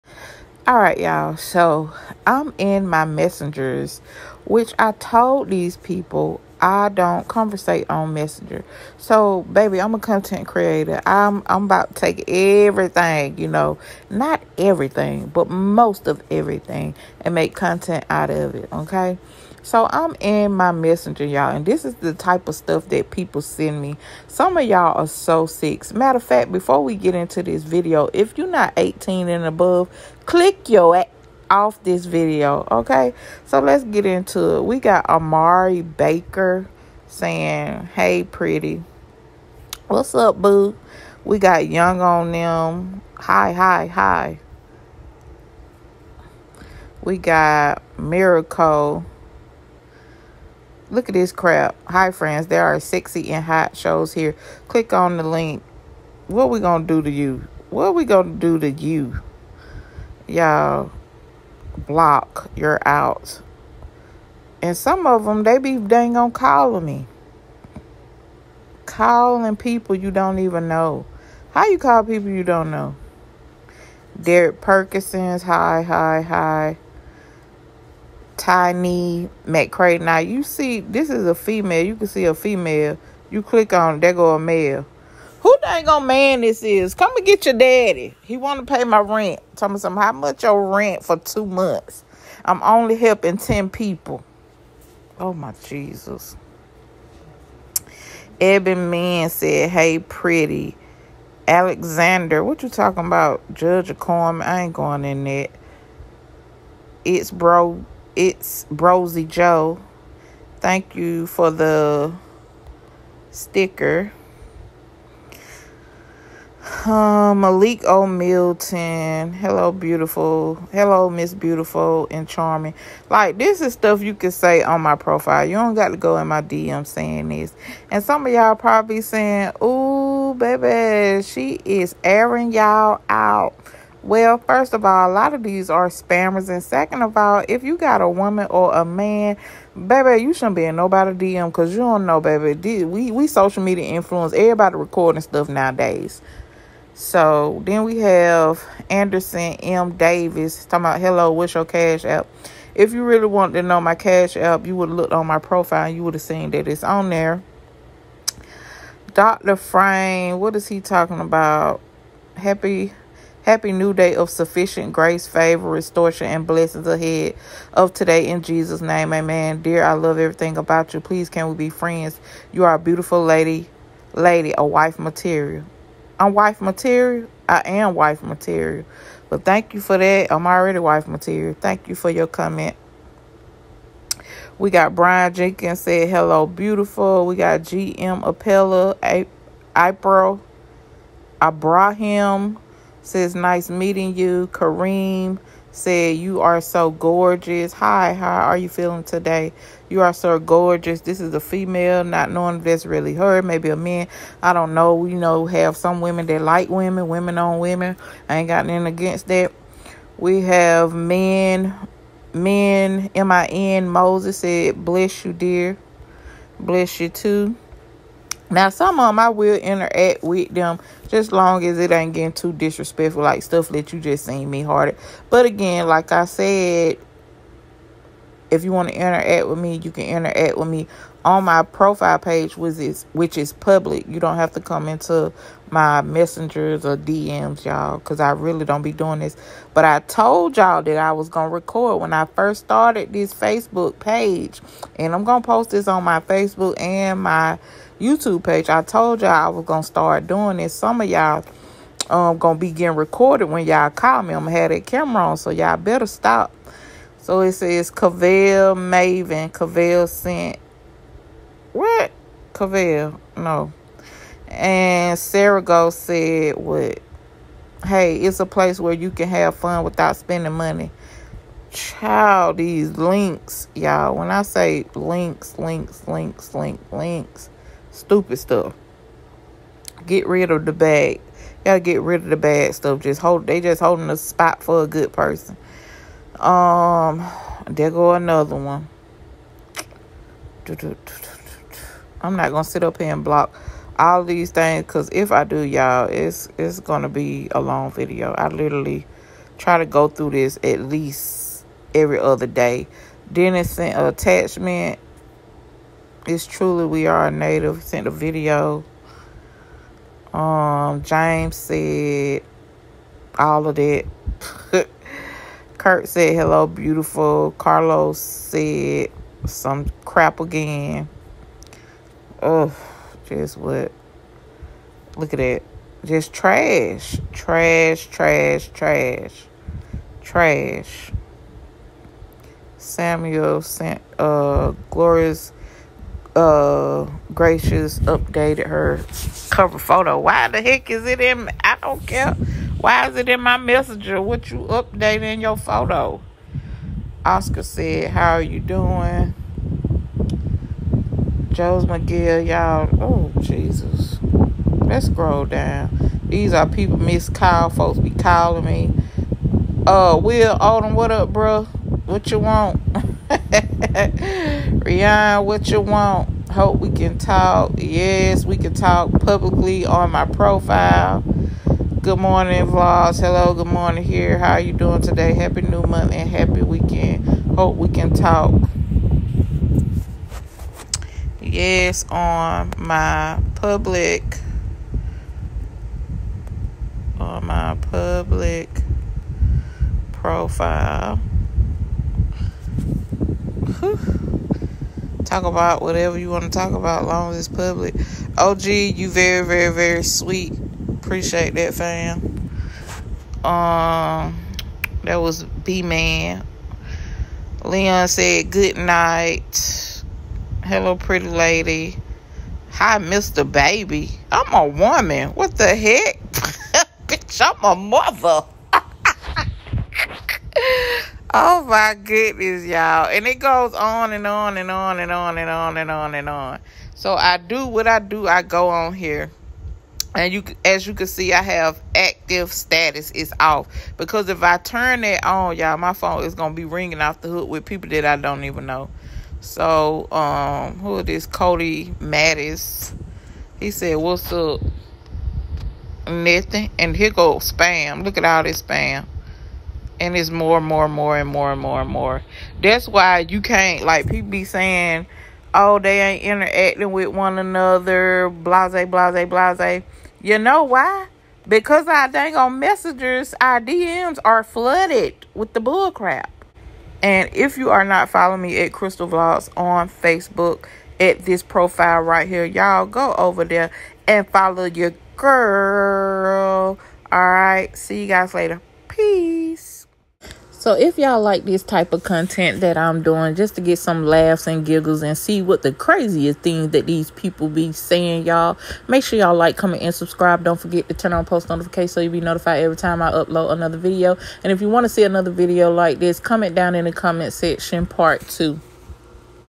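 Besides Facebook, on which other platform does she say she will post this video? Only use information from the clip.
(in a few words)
YouTube.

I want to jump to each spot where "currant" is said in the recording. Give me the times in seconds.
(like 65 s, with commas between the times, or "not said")
not said.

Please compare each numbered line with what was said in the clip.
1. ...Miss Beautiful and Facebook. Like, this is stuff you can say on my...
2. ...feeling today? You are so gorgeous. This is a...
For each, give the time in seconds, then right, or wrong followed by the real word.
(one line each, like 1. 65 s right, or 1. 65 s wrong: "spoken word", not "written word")
1. 121 s wrong: "Charming", not "Facebook"
2. 198 s right.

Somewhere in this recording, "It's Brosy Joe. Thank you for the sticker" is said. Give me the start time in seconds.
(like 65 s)
108 s.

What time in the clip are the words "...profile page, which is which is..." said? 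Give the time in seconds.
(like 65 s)
231 s.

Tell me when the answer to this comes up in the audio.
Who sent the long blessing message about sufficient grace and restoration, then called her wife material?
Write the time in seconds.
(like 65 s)
159 s.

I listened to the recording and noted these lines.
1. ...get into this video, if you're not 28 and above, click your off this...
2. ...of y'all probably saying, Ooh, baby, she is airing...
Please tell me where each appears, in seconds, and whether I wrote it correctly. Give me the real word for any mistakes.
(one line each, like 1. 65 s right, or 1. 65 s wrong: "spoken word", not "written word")
1. 26 s wrong: "18", not "28"
2. 128 s right.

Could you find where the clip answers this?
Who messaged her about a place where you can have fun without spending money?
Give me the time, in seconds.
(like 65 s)
265 s.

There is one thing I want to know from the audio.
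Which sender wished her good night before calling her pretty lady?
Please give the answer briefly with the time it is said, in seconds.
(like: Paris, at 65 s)
Leon, at 407 s.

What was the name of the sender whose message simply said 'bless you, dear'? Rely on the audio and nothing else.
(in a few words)
Moses.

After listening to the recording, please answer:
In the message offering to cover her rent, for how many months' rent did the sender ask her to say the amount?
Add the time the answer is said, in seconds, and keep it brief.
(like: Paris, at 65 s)
2 months, at 91 s.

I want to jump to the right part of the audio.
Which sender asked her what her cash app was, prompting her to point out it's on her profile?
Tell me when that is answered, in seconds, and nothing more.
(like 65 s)
148 s.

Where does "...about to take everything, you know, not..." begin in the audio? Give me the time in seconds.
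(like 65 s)
11 s.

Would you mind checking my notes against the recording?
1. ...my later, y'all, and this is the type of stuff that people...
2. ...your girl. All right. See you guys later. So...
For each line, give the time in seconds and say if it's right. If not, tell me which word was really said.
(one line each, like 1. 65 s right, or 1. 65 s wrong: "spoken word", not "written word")
1. 20 s wrong: "messenger", not "later"
2. 474 s right.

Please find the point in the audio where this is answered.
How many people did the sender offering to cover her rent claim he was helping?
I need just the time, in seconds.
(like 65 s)
93 s.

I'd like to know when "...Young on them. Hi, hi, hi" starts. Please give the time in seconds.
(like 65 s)
41 s.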